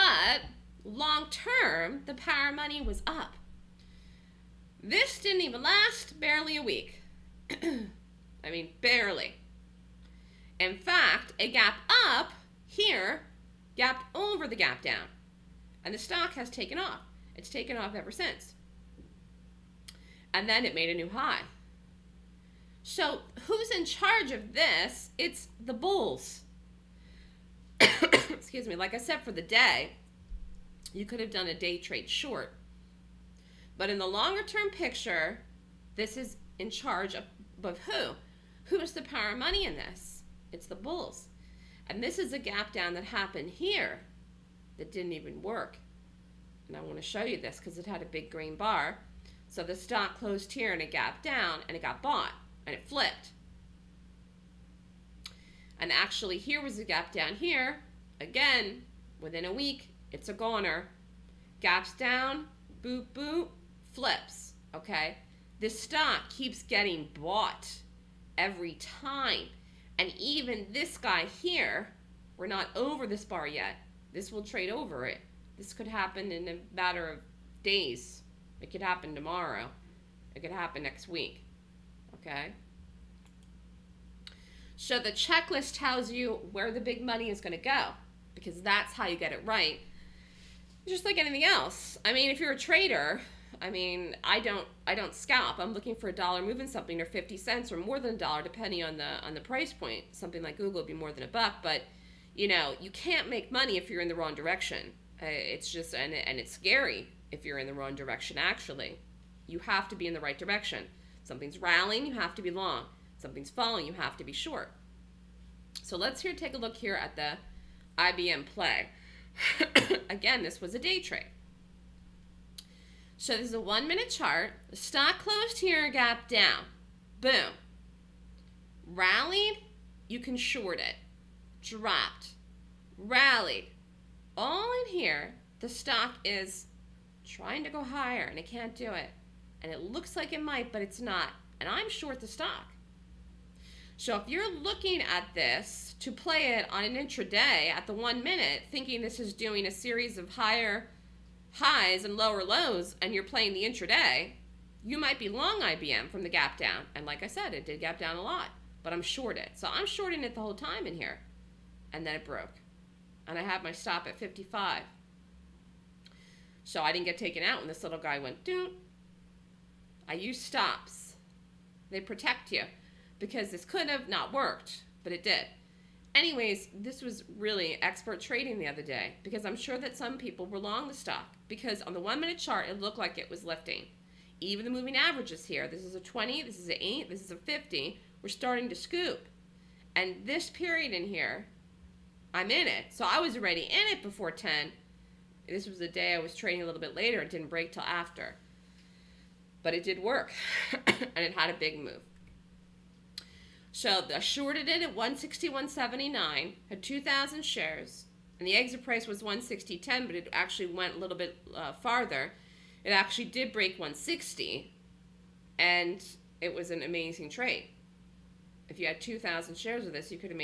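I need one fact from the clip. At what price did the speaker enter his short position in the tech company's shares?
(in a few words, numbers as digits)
161.79.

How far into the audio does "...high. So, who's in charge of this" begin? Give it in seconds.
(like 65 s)
21 s.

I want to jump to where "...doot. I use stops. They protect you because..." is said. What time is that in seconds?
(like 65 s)
168 s.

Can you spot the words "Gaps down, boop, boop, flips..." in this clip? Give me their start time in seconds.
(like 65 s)
61 s.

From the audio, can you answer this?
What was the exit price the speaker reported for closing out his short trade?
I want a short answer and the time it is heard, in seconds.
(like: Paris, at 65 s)
160.10, at 209 s.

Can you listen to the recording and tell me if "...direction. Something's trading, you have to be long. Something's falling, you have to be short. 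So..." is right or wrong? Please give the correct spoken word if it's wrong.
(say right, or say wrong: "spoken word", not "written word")
wrong: "rallying", not "trading".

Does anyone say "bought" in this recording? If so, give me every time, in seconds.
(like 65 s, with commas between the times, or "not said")
52 s, 67 s.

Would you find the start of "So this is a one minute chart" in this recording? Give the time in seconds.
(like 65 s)
123 s.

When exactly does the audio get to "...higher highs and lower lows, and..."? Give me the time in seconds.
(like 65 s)
150 s.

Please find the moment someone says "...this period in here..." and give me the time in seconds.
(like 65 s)
190 s.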